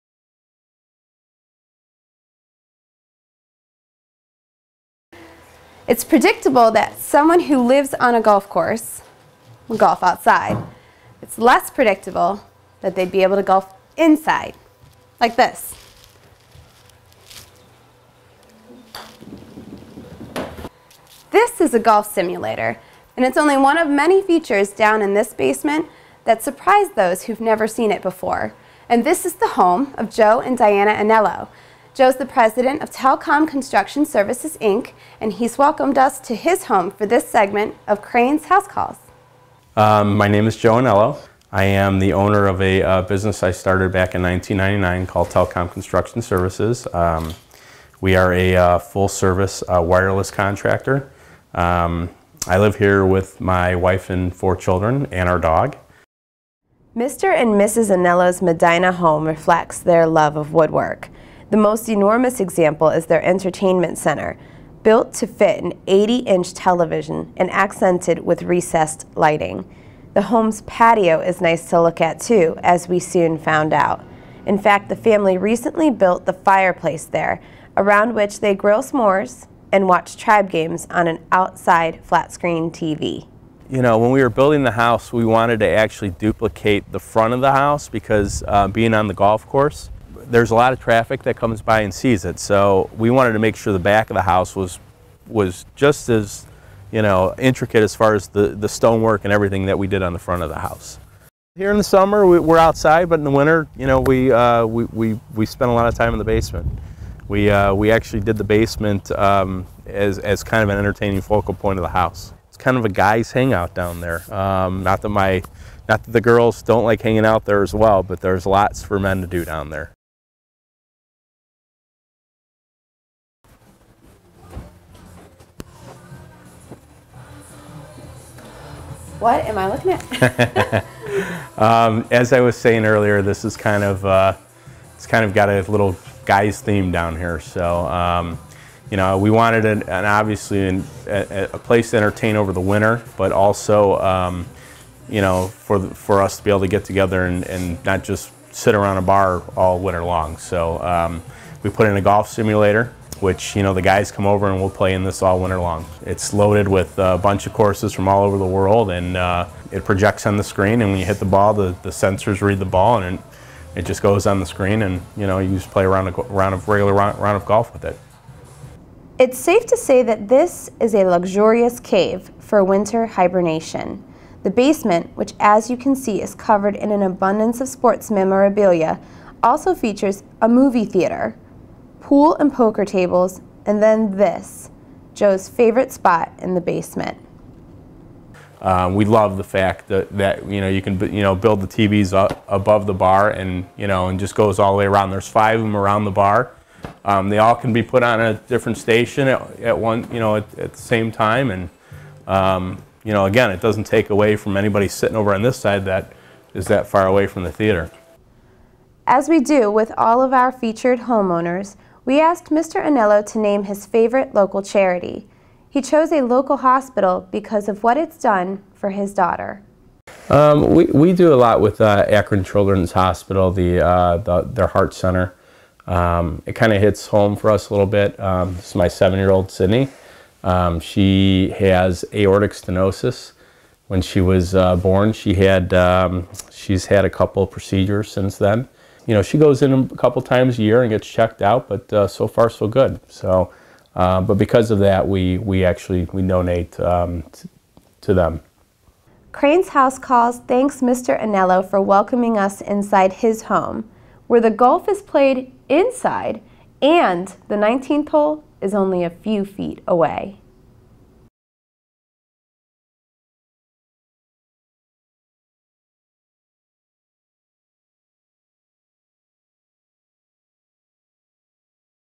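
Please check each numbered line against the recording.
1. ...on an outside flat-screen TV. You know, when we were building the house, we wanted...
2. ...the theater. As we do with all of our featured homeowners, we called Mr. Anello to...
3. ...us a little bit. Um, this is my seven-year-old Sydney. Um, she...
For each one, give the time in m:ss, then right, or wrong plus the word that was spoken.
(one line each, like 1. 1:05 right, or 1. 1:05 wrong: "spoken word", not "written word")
1. 1:20 right
2. 3:27 wrong: "asked", not "called"
3. 3:47 right.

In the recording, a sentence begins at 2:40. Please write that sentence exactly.
And when you hit the ball, the, the sensors read the ball, and it, just goes on the screen.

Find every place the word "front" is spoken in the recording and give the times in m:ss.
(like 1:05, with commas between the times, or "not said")
1:27, 1:40.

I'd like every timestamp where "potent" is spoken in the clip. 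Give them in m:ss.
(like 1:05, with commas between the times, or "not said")
not said.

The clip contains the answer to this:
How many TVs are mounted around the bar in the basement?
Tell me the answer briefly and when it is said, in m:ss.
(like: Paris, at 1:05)
5, at 3:15.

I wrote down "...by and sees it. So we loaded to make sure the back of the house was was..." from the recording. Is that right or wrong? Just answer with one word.
wrong.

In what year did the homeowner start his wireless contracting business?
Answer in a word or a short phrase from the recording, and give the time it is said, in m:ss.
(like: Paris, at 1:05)
1999, at 0:44.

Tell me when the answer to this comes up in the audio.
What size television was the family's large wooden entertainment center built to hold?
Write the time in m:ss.
1:05.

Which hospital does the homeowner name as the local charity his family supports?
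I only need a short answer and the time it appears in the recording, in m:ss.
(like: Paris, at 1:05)
Akron Children's Hospital, at 3:42.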